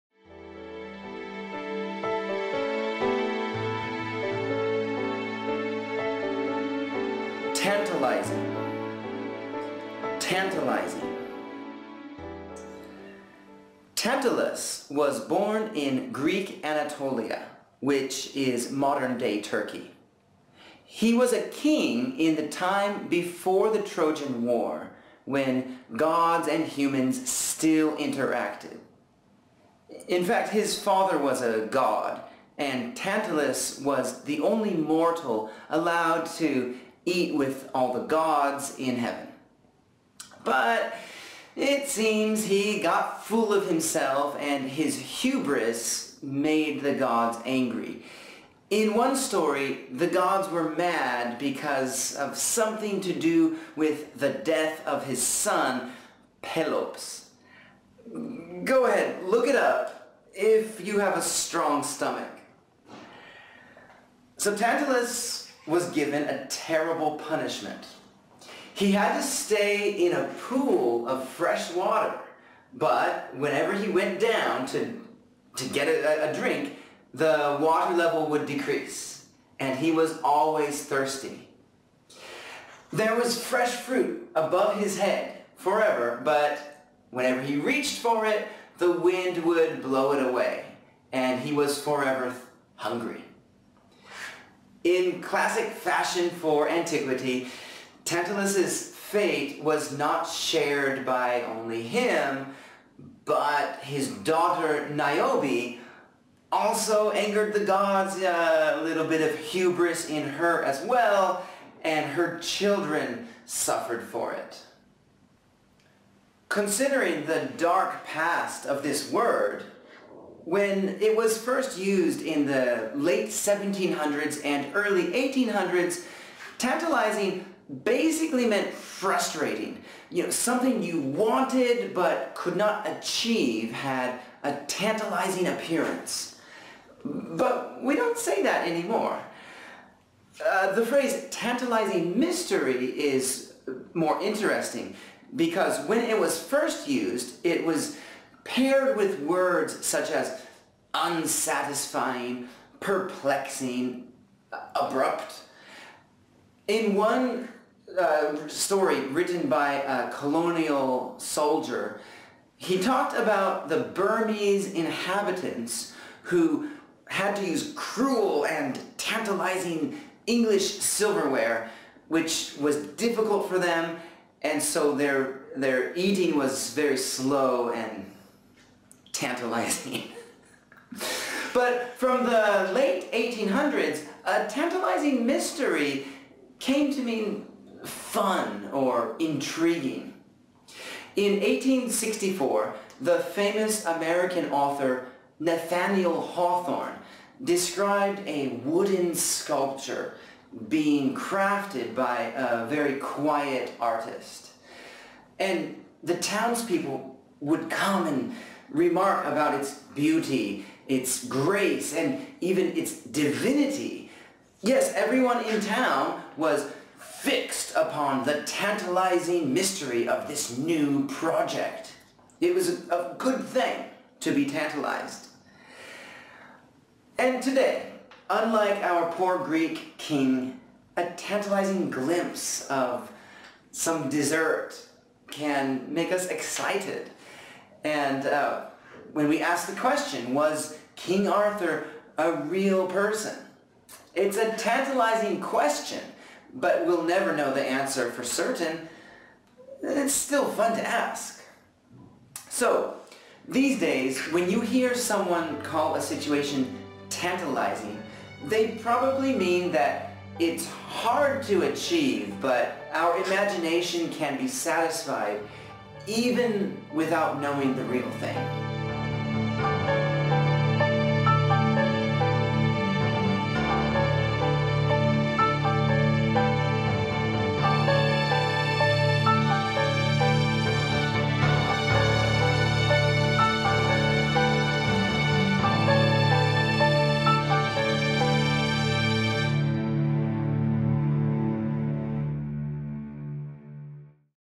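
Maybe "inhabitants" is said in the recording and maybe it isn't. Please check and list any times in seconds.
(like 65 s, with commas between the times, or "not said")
164 s.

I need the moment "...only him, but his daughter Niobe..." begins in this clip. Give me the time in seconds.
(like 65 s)
101 s.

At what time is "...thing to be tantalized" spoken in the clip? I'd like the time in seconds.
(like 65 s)
223 s.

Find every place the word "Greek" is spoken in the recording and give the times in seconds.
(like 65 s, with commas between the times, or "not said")
16 s, 229 s.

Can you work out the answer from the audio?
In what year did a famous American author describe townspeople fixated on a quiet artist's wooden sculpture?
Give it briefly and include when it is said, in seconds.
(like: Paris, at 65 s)
1864, at 191 s.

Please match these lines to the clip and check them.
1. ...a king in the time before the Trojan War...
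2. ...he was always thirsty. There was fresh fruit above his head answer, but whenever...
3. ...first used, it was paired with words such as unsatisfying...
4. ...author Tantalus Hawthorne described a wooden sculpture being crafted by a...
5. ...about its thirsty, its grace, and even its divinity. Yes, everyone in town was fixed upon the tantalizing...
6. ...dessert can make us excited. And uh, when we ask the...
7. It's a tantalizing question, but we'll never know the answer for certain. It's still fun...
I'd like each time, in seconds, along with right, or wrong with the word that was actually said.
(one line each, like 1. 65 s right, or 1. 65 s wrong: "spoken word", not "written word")
1. 21 s right
2. 79 s wrong: "forever", not "answer"
3. 146 s right
4. 194 s wrong: "Nathaniel", not "Tantalus"
5. 209 s wrong: "beauty", not "thirsty"
6. 234 s right
7. 244 s right.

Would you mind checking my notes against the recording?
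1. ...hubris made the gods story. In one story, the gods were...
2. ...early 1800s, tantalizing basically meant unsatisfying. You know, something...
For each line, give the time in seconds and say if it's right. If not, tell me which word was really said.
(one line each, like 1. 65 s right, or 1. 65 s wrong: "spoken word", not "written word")
1. 44 s wrong: "angry", not "story"
2. 124 s wrong: "frustrating", not "unsatisfying".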